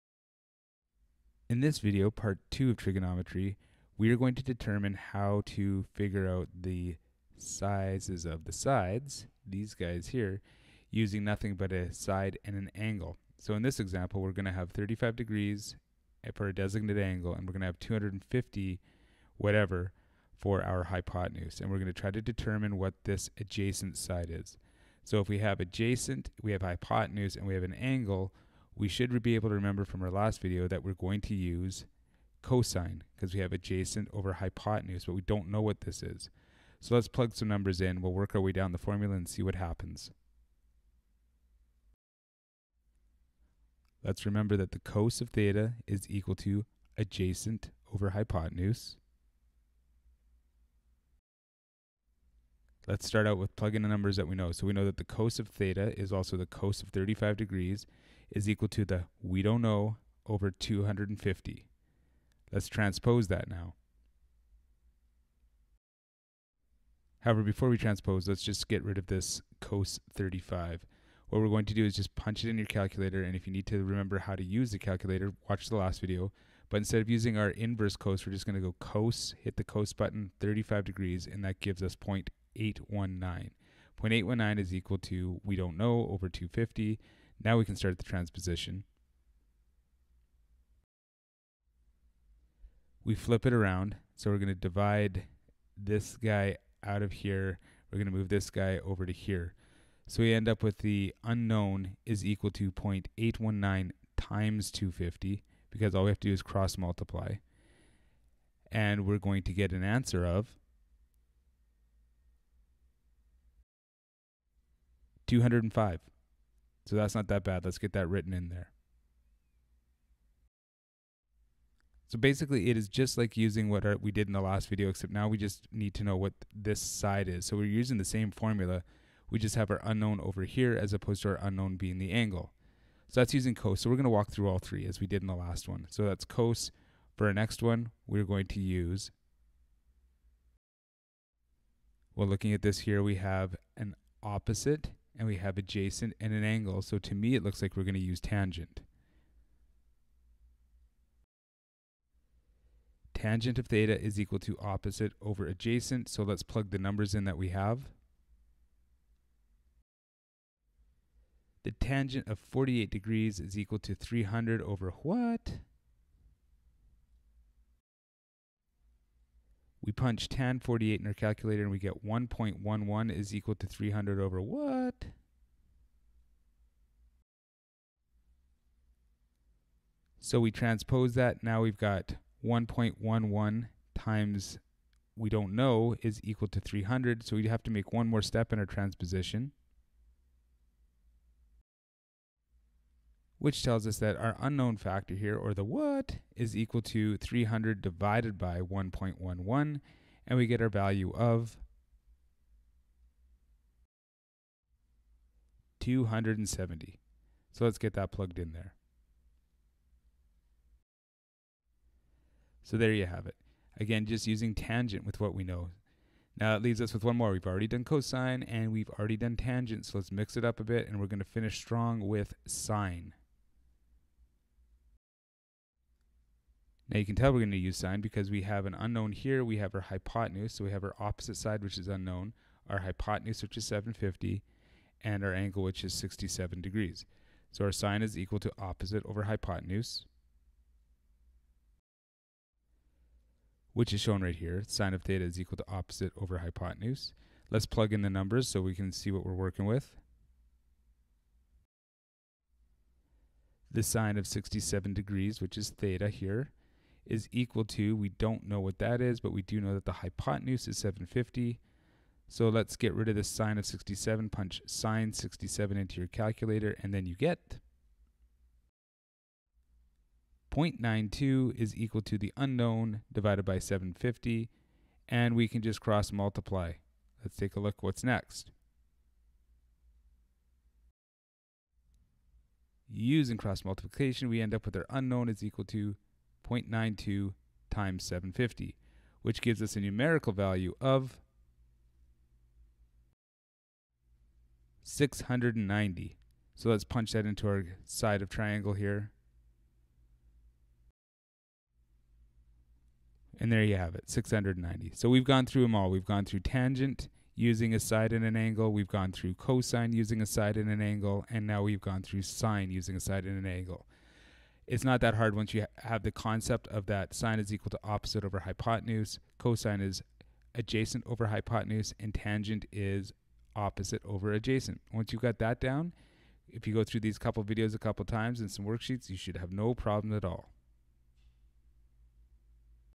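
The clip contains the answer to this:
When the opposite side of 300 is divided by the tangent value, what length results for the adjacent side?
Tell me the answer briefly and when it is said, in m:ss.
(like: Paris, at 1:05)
270, at 3:25.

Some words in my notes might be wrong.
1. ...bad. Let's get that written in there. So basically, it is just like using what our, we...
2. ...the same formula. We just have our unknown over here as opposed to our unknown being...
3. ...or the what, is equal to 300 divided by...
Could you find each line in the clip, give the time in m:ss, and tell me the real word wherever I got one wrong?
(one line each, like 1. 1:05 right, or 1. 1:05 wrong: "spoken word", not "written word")
1. 1:57 right
2. 2:07 right
3. 3:15 right.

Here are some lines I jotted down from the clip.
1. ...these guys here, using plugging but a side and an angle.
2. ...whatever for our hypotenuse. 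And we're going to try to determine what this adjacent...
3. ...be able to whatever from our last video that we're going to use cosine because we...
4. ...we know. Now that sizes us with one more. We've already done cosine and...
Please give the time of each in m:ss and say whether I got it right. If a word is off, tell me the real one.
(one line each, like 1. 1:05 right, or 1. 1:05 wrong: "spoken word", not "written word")
1. 0:09 wrong: "nothing", not "plugging"
2. 0:19 right
3. 0:29 wrong: "remember", not "whatever"
4. 3:35 wrong: "leaves", not "sizes".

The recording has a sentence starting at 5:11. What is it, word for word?
And now we've gone through sine using a side and an angle.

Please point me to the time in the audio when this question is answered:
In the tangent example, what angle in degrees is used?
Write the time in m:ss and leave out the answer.
2:42.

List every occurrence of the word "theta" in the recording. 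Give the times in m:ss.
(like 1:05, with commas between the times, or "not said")
0:45, 0:55, 2:33, 4:05, 4:15.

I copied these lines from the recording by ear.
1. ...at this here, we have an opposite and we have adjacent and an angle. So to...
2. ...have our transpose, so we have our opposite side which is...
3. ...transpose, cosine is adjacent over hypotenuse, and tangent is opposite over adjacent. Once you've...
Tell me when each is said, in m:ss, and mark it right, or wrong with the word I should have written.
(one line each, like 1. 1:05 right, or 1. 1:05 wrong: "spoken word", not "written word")
1. 2:22 right
2. 3:49 wrong: "hypotenuse", not "transpose"
3. 5:18 wrong: "hypotenuse", not "transpose".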